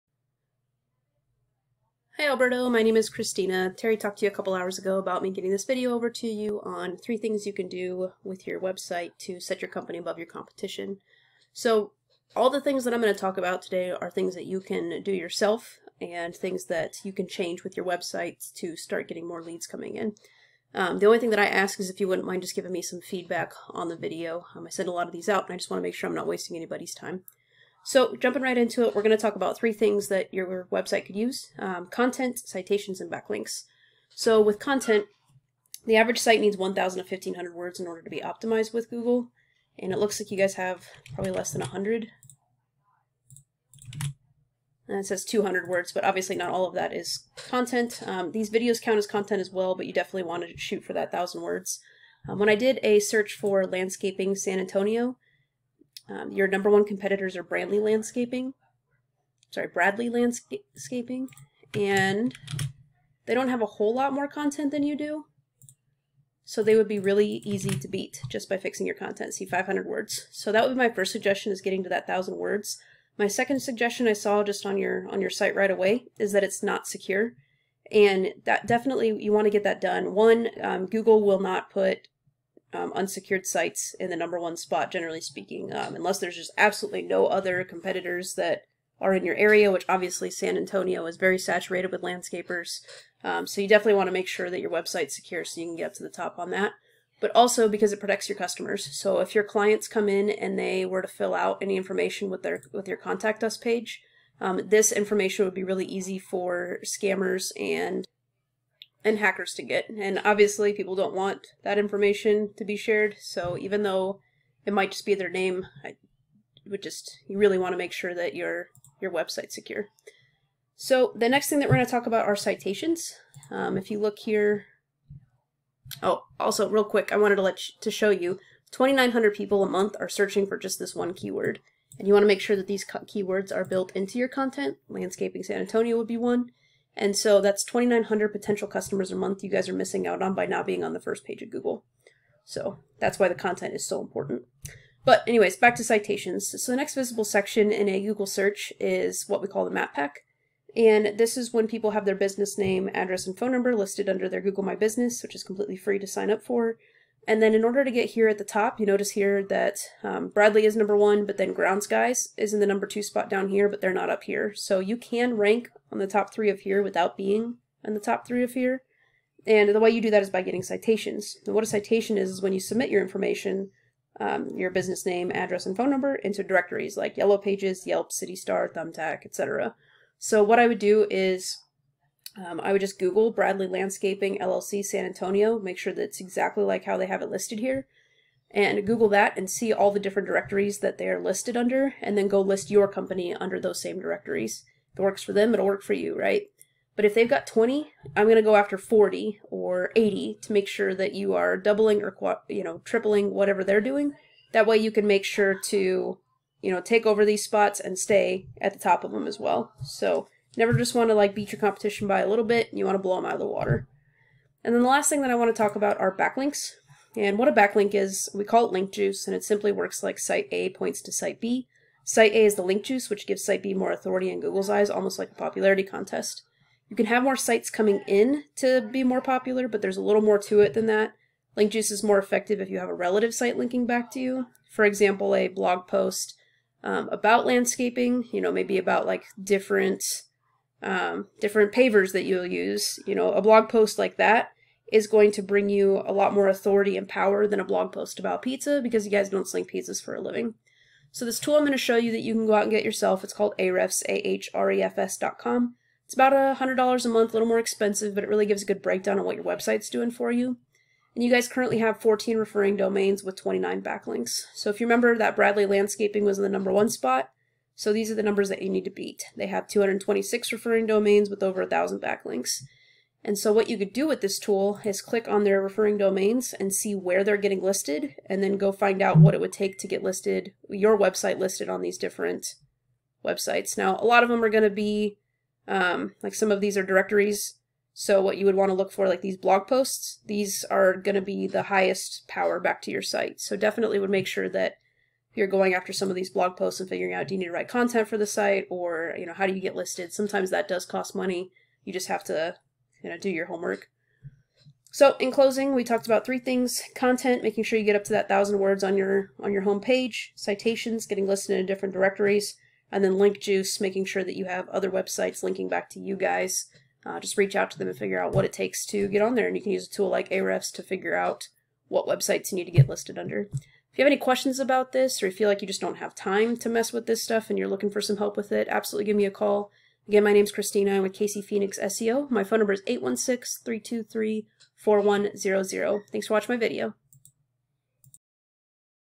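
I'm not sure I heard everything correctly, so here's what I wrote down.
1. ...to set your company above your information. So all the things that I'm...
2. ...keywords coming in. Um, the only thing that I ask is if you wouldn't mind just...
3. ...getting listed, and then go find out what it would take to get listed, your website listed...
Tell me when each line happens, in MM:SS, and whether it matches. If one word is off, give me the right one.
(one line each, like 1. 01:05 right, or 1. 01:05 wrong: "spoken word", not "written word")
1. 00:09 wrong: "competition", not "information"
2. 00:19 wrong: "leads", not "keywords"
3. 04:37 right.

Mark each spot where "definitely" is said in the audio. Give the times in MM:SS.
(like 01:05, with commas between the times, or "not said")
00:49, 01:18, 01:33, 04:53.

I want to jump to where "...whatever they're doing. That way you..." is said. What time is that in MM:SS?
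03:23.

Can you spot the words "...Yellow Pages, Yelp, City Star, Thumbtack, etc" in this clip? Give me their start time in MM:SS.
02:57.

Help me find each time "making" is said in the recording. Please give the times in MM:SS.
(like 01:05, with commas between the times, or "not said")
05:07, 05:13.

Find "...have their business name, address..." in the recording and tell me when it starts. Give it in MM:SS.
02:31.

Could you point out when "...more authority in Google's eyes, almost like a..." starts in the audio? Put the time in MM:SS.
03:43.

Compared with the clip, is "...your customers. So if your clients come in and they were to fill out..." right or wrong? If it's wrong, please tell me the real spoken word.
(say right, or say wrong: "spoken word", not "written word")
right.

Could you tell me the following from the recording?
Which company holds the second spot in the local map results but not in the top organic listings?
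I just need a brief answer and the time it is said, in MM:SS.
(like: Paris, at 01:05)
Grounds Guys, at 02:41.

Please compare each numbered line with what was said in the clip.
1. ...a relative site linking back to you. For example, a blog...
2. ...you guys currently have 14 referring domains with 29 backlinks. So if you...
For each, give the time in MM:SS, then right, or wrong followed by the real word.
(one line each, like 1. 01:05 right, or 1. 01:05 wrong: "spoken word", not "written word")
1. 03:52 right
2. 04:21 right.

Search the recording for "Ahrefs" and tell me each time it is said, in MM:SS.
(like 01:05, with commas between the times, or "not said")
04:13, 05:20.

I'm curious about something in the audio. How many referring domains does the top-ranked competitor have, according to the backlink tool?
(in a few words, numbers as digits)
226.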